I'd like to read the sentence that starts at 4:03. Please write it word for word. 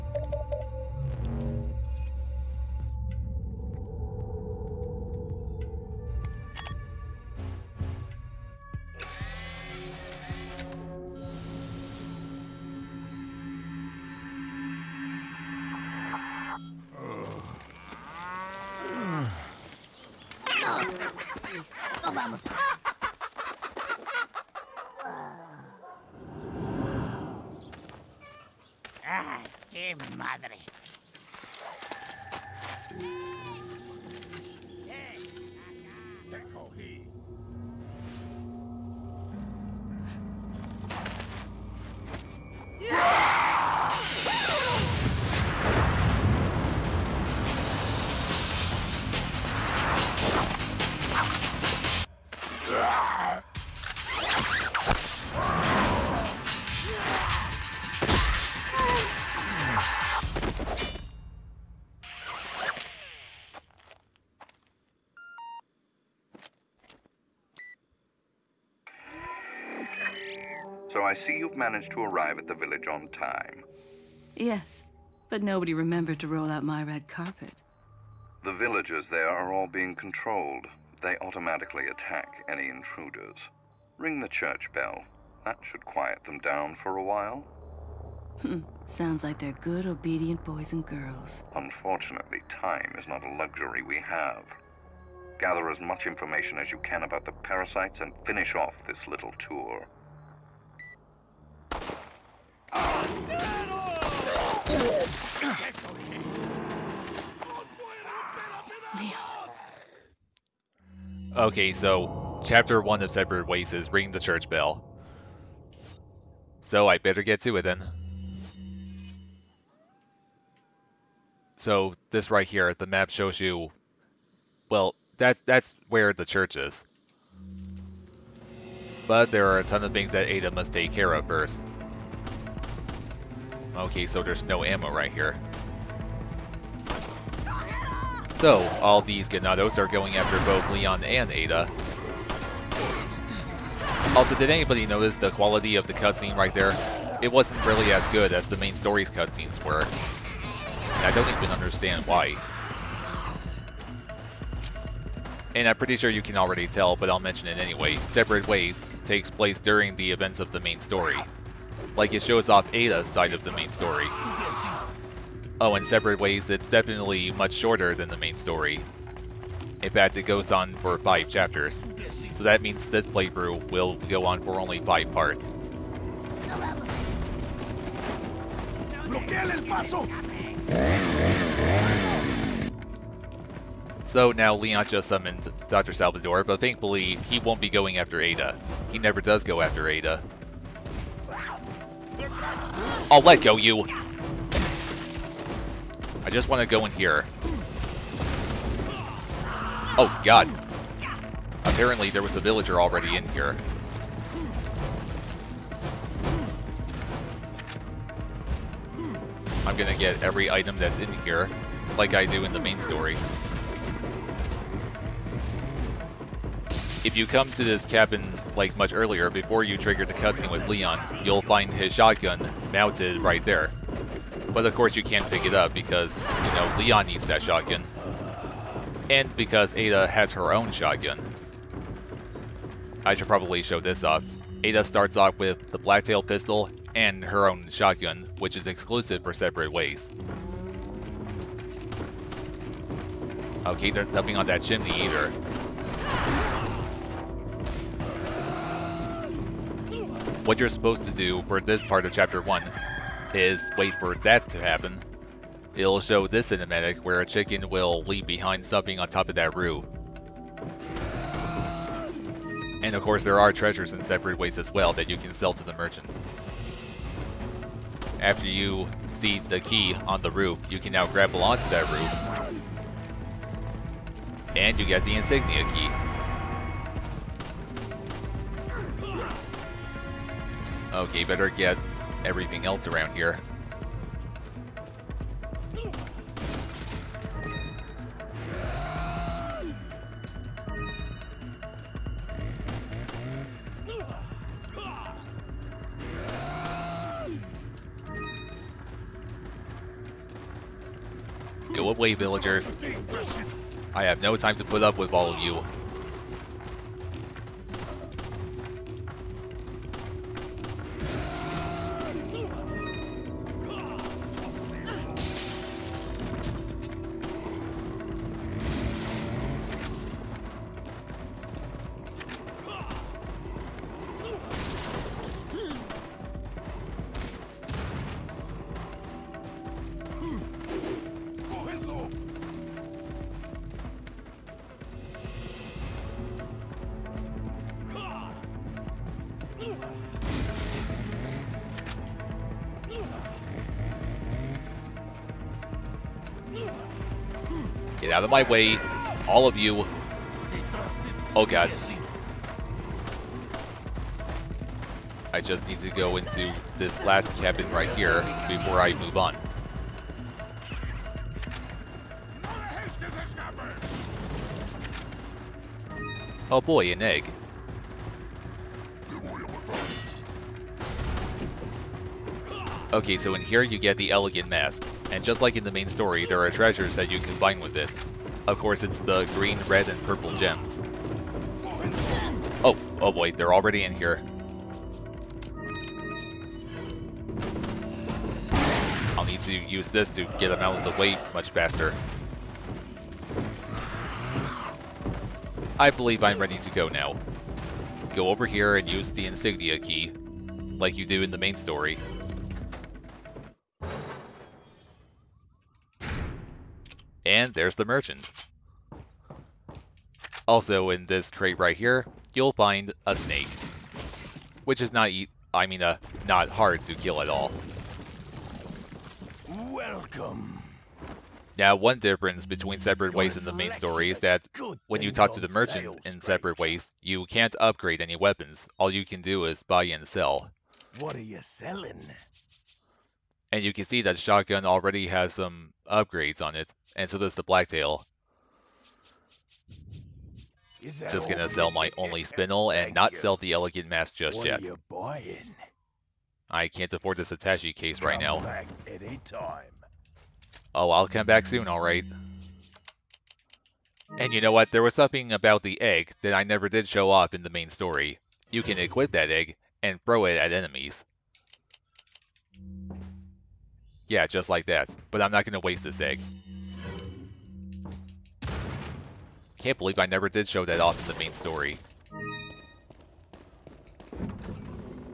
Okay, there's nothing on that chimney either.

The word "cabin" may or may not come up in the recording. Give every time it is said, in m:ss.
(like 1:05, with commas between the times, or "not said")
3:37, 5:57.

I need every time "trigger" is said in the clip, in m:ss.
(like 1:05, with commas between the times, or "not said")
3:39.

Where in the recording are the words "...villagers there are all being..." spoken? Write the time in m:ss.
1:18.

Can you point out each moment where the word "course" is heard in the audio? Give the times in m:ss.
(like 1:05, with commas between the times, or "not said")
3:44, 4:23, 6:18.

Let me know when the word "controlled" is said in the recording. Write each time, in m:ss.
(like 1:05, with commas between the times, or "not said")
1:19.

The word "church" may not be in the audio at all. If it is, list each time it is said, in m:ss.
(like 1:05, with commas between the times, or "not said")
1:24, 1:54, 2:06.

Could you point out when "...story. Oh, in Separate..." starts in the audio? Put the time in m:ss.
2:43.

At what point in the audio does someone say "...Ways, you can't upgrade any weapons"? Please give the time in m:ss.
7:06.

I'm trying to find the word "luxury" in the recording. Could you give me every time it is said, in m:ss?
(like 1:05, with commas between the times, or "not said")
1:33.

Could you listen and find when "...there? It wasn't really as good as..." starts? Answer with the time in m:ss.
2:26.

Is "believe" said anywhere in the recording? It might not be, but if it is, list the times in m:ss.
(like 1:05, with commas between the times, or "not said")
6:35, 7:49.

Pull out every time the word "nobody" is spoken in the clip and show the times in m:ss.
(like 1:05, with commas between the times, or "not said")
1:15.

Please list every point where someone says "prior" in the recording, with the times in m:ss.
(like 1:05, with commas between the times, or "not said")
not said.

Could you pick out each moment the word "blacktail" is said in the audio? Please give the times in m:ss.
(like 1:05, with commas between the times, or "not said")
3:55, 7:17.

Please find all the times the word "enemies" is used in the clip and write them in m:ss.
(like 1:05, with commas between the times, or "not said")
7:40.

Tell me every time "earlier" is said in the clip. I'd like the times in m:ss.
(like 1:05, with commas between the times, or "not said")
3:38.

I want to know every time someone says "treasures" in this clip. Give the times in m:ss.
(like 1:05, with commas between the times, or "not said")
4:23, 6:16.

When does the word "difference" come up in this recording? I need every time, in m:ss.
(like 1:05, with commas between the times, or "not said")
7:01.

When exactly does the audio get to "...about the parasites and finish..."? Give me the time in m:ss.
1:37.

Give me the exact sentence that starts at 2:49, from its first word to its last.
In fact, it goes on for five chapters.